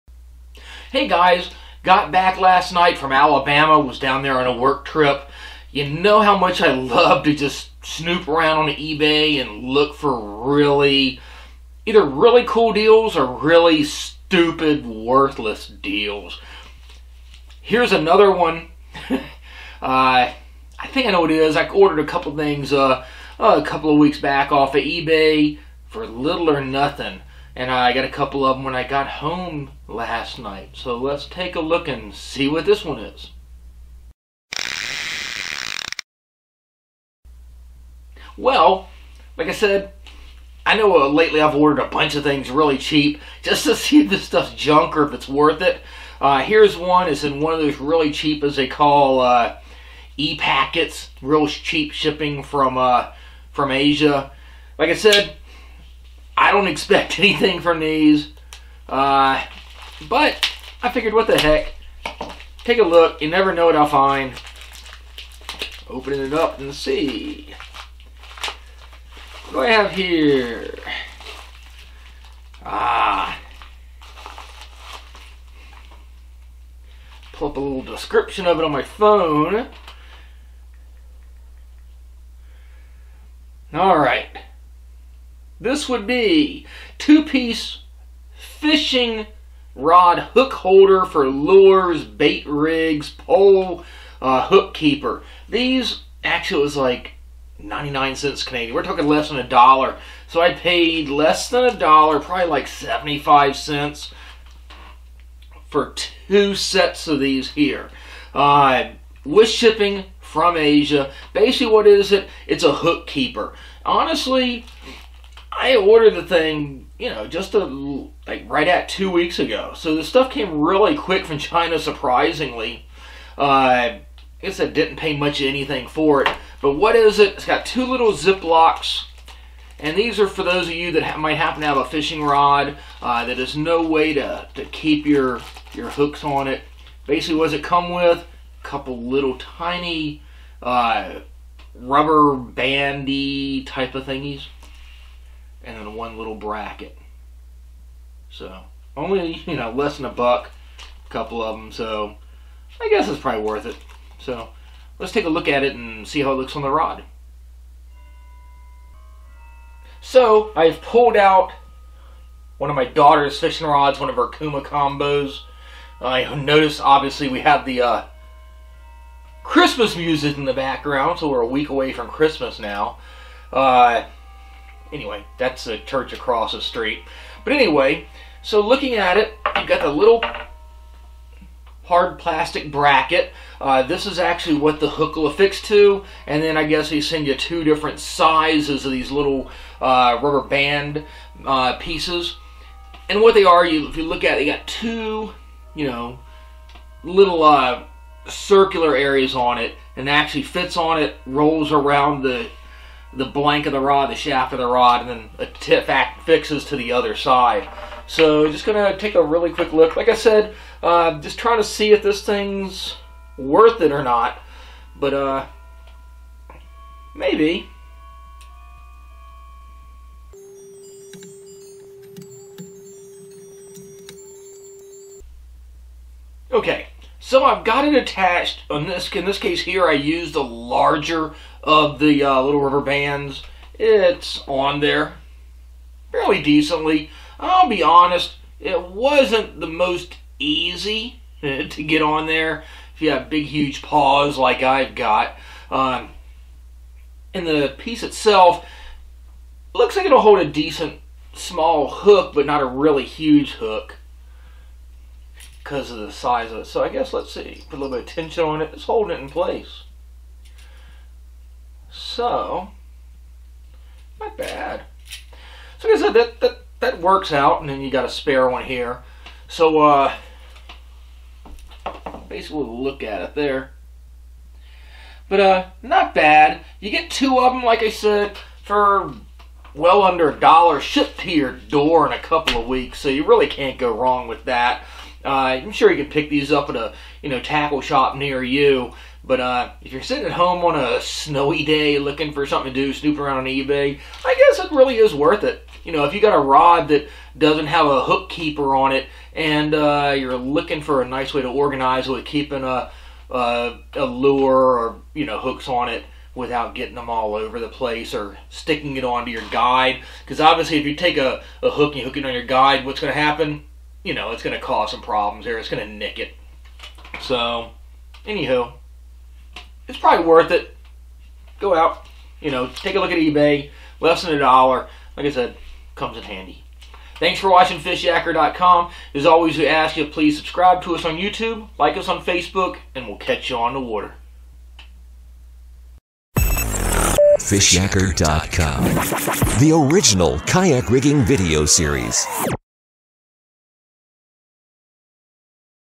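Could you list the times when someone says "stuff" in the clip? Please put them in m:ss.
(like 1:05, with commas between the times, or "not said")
0:44, 2:00.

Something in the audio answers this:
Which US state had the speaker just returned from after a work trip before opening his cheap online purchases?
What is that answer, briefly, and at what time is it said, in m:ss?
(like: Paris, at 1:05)
Alabama, at 0:03.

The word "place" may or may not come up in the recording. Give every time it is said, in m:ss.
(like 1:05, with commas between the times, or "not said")
4:19, 5:07.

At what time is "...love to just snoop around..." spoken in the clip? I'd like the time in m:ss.
0:06.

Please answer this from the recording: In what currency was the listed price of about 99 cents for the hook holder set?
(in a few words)
Canadian.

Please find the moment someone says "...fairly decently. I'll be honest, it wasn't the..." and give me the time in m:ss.
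3:56.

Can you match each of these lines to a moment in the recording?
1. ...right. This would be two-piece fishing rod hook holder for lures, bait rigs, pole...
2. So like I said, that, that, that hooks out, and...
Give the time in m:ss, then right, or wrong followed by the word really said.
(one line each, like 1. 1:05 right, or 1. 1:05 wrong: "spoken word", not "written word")
1. 1:23 right
2. 4:25 wrong: "works", not "hooks".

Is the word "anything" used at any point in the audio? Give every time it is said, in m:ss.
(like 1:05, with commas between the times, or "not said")
0:57, 2:05.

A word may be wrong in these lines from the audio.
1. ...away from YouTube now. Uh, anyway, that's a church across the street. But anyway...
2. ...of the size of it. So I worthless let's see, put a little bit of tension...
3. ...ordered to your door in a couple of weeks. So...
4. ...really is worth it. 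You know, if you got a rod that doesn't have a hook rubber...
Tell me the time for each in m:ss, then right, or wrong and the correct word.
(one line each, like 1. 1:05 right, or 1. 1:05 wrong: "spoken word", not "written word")
1. 2:51 wrong: "Christmas", not "YouTube"
2. 4:15 wrong: "guess", not "worthless"
3. 4:40 wrong: "shipped", not "ordered"
4. 4:54 wrong: "keeper", not "rubber".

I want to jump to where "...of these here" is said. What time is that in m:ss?
1:47.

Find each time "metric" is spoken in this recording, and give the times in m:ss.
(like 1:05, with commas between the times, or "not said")
not said.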